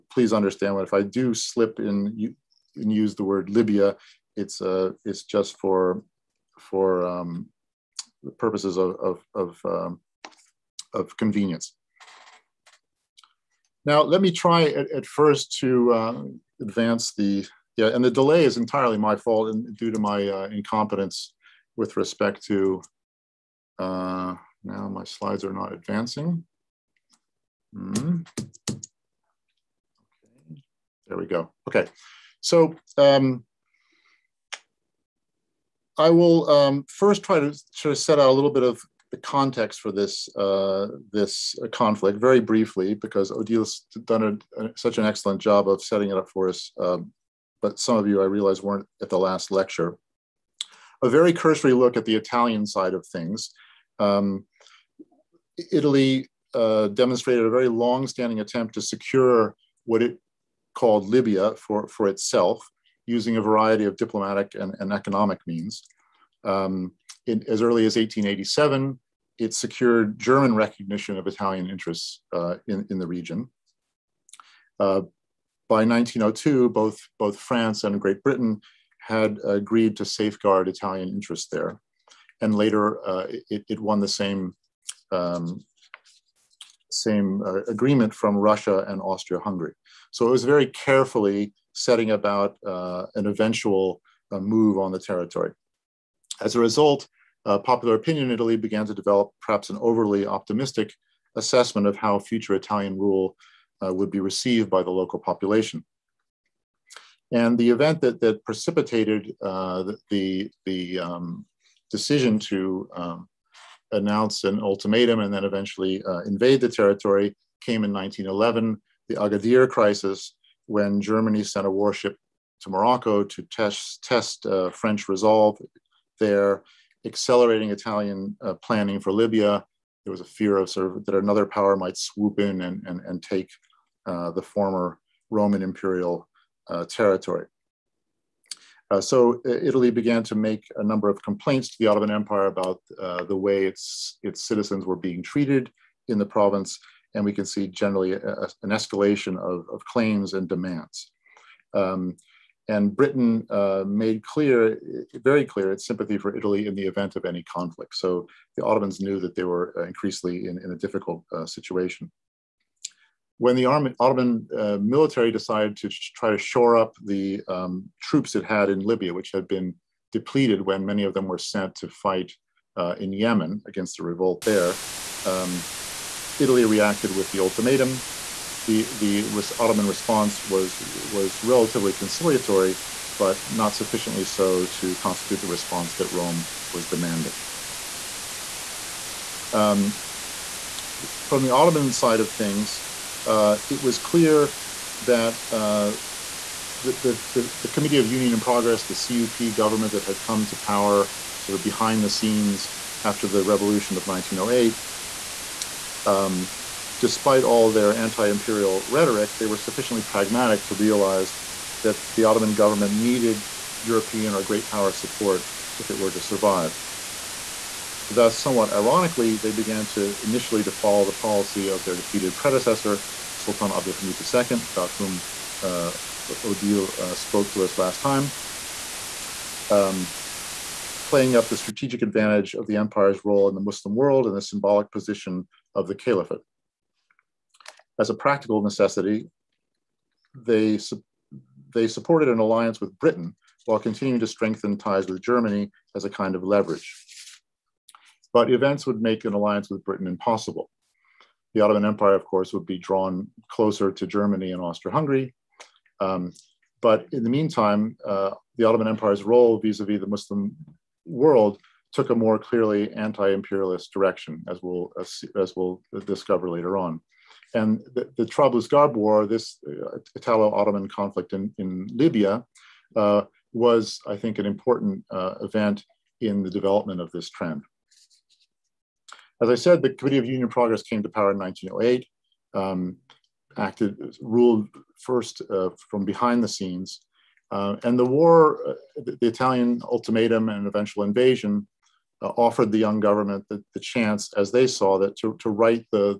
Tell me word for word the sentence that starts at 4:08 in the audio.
But events would make an alliance with Britain impossible.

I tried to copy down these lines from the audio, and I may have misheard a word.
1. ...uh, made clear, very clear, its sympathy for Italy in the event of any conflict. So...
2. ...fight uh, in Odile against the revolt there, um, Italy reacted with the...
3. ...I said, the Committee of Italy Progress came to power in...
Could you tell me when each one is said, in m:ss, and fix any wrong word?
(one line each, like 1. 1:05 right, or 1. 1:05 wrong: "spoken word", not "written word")
1. 2:33 right
2. 2:51 wrong: "Yemen", not "Odile"
3. 4:39 wrong: "Union", not "Italy".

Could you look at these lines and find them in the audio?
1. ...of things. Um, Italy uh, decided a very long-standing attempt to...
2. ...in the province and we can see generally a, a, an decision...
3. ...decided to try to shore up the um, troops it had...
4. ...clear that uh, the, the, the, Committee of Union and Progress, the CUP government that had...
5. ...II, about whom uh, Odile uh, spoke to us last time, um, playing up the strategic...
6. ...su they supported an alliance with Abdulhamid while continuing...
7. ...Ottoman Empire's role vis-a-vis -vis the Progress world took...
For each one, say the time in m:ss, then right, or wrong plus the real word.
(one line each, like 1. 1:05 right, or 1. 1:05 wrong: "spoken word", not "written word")
1. 0:52 wrong: "demonstrated", not "decided"
2. 2:26 wrong: "escalation", not "decision"
3. 2:45 right
4. 3:13 right
5. 3:44 right
6. 4:00 wrong: "Britain", not "Abdulhamid"
7. 4:18 wrong: "Muslim", not "Progress".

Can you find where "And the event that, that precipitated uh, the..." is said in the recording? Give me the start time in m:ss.
1:47.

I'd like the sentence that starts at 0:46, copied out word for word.
Um, but some of you, I realize, weren't at the last lecture.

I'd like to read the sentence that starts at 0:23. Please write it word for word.
Uh, now my slides are not advancing.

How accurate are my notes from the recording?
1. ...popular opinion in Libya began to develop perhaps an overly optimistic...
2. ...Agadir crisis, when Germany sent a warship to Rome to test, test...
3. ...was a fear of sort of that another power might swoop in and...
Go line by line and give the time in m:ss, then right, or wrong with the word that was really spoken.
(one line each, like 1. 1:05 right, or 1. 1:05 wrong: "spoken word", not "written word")
1. 1:37 wrong: "Italy", not "Libya"
2. 1:59 wrong: "Morocco", not "Rome"
3. 2:10 right.